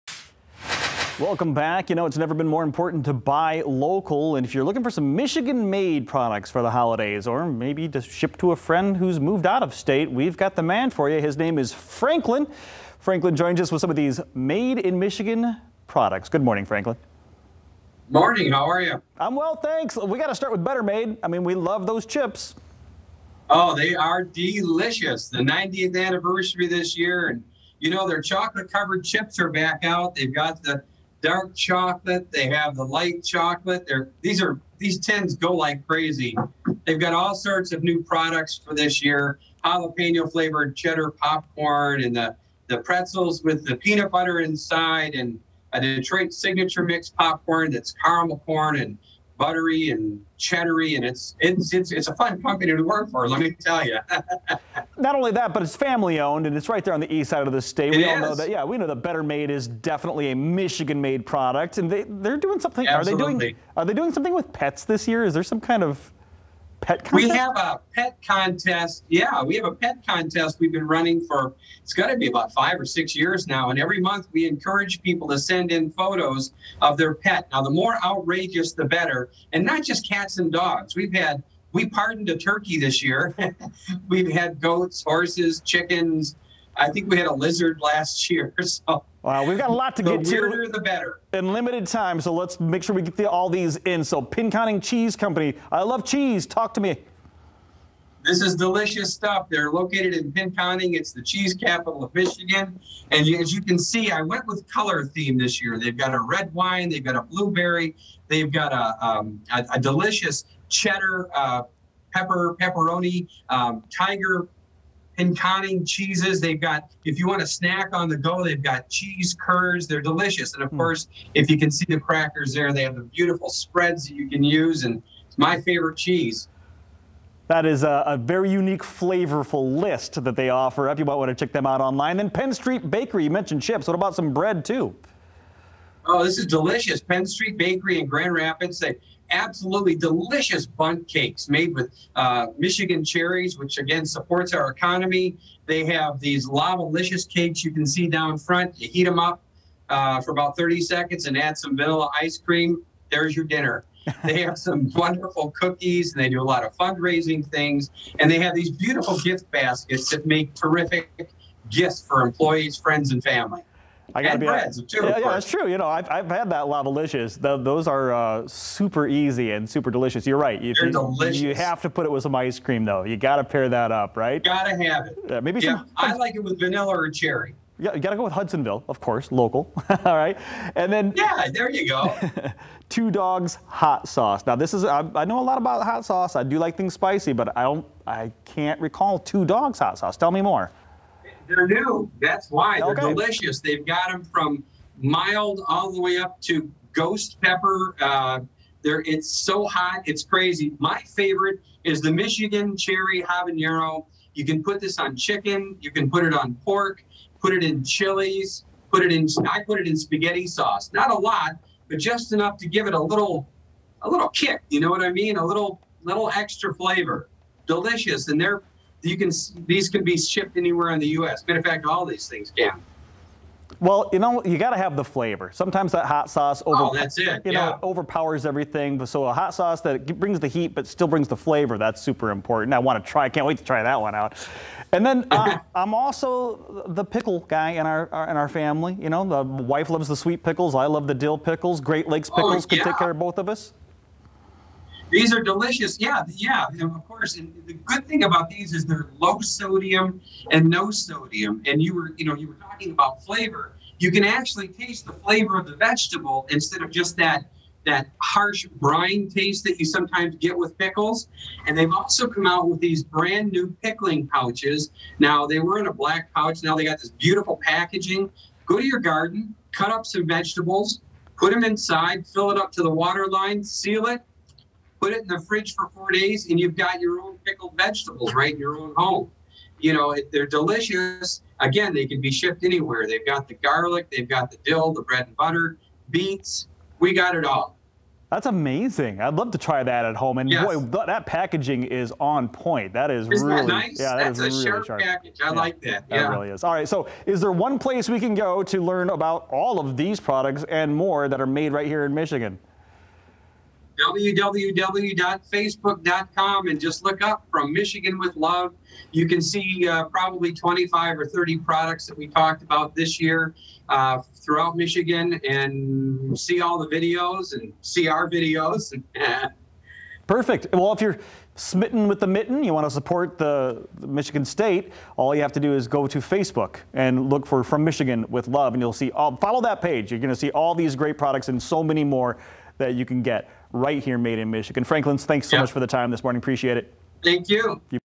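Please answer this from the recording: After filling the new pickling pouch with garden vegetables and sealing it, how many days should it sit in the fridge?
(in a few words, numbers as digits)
4.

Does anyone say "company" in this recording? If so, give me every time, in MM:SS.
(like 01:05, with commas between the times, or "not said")
00:52, 01:35.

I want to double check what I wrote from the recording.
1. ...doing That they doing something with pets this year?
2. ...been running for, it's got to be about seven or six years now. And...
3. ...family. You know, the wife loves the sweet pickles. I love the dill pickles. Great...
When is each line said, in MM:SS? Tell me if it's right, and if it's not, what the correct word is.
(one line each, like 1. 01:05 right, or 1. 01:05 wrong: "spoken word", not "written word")
1. 01:03 wrong: "Are", not "That"
2. 01:10 wrong: "five", not "seven"
3. 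03:58 right.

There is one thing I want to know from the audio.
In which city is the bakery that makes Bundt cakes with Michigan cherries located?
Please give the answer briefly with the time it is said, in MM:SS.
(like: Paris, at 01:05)
Grand Rapids, at 02:18.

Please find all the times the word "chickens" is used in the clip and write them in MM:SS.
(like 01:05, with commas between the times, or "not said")
01:25, 03:25.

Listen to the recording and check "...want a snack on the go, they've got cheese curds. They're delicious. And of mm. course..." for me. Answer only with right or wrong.
right.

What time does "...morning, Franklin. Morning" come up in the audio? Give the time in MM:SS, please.
00:16.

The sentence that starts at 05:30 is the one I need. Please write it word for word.
You're going to see all these great products and so many more that you can get right here, made in Michigan.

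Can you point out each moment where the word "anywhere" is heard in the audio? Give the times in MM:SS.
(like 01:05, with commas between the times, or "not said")
03:40, 04:42.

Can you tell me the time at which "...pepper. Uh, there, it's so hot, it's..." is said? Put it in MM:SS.
03:17.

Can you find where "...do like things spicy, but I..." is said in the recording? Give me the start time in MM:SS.
03:06.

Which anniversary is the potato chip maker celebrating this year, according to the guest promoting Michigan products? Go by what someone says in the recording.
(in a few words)
90th.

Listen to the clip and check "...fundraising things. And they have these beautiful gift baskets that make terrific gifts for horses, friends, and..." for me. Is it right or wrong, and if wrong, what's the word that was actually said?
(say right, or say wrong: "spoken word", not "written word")
wrong: "employees", not "horses".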